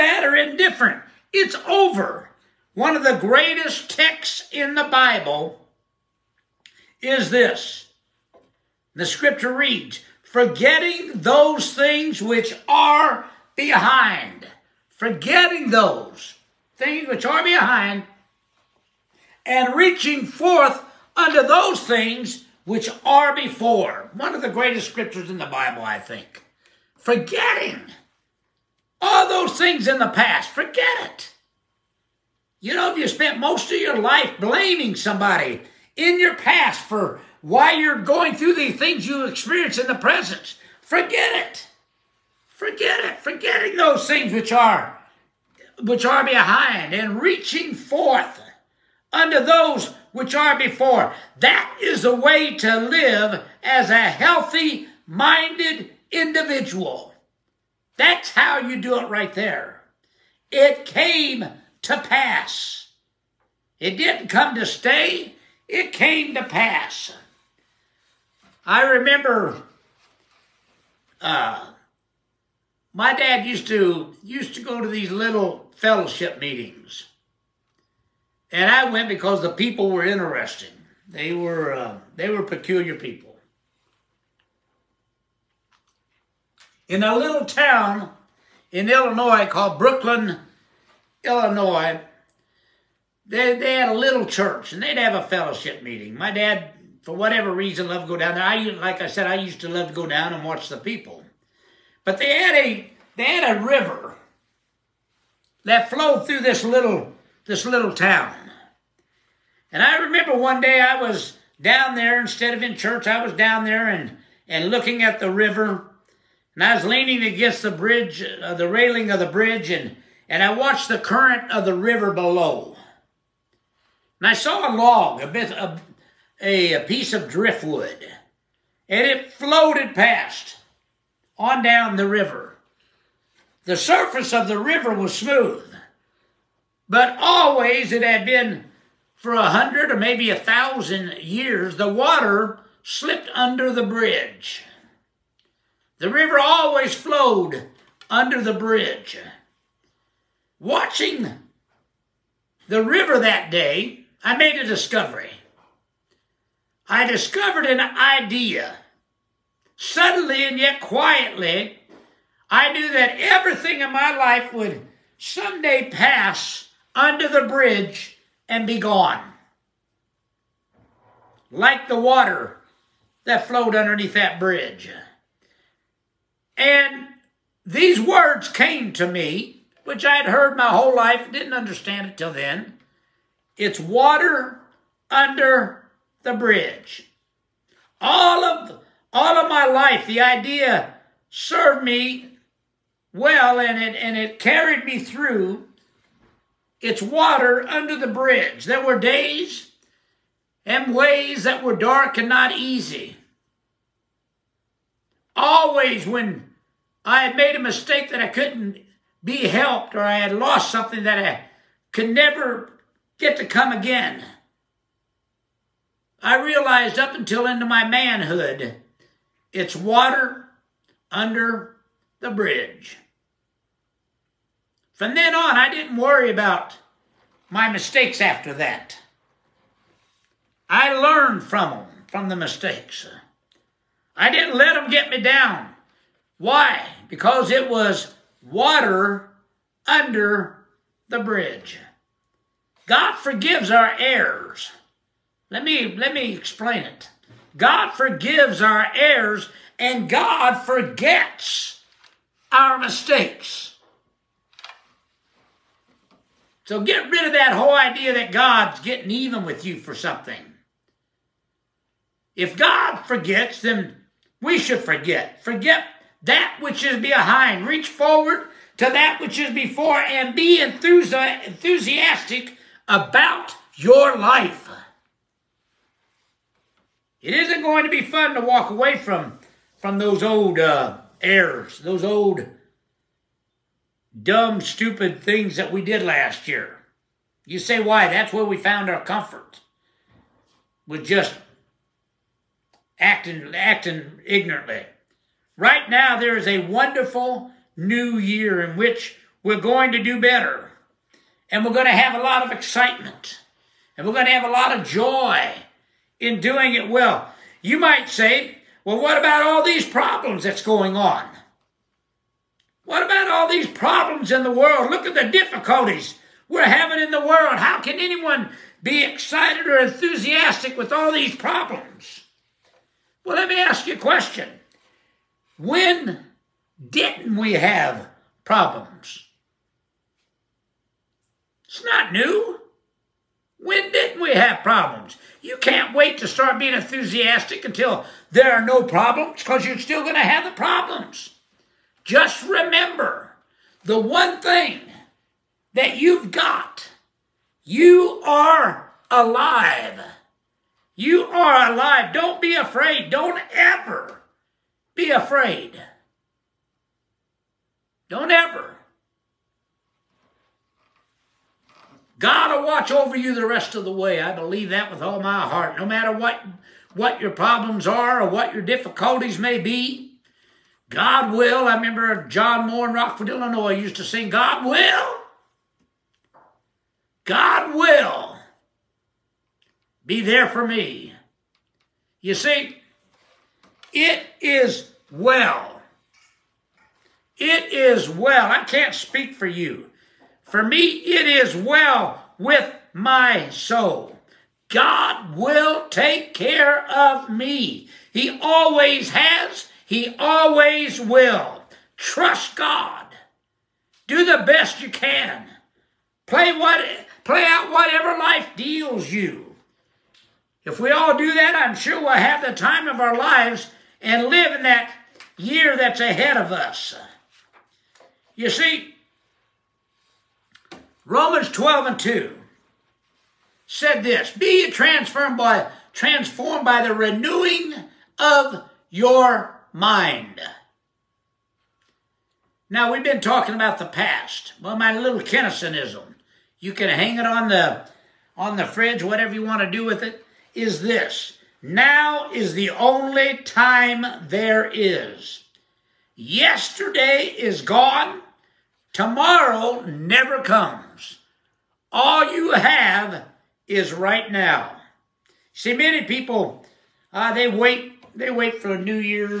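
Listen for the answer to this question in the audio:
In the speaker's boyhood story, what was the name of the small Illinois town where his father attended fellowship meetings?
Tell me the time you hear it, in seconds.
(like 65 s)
89 s.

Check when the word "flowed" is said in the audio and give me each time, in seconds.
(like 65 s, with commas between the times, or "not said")
105 s, 146 s, 173 s.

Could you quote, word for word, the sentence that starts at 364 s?
I believe that with all my heart.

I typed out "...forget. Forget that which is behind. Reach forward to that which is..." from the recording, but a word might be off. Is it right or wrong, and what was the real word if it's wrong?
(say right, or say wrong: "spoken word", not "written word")
right.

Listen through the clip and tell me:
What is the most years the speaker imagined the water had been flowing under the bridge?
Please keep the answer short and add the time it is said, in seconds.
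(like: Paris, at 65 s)
1000, at 140 s.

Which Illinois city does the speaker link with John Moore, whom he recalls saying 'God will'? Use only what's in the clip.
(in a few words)
Rockford.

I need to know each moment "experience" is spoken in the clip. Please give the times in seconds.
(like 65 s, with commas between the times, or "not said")
39 s.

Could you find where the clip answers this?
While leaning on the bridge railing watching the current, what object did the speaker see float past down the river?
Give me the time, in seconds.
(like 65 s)
126 s.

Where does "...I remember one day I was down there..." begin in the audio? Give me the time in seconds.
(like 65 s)
109 s.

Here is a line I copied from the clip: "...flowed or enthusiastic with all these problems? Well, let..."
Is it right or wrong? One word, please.
wrong.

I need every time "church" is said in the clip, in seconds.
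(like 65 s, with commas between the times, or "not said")
94 s, 112 s.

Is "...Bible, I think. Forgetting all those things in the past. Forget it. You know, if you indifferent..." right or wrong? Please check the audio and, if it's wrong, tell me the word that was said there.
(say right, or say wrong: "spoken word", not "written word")
wrong: "spent", not "indifferent".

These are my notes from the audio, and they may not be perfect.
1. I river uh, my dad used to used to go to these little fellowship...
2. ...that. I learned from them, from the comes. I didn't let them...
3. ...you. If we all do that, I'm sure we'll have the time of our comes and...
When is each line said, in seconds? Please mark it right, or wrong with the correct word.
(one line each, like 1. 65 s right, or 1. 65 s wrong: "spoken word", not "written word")
1. 68 s wrong: "remember", not "river"
2. 228 s wrong: "mistakes", not "comes"
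3. 409 s wrong: "lives", not "comes".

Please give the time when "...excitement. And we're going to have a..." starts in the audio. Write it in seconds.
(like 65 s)
302 s.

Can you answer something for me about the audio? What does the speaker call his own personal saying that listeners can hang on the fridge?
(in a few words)
Kinisonism.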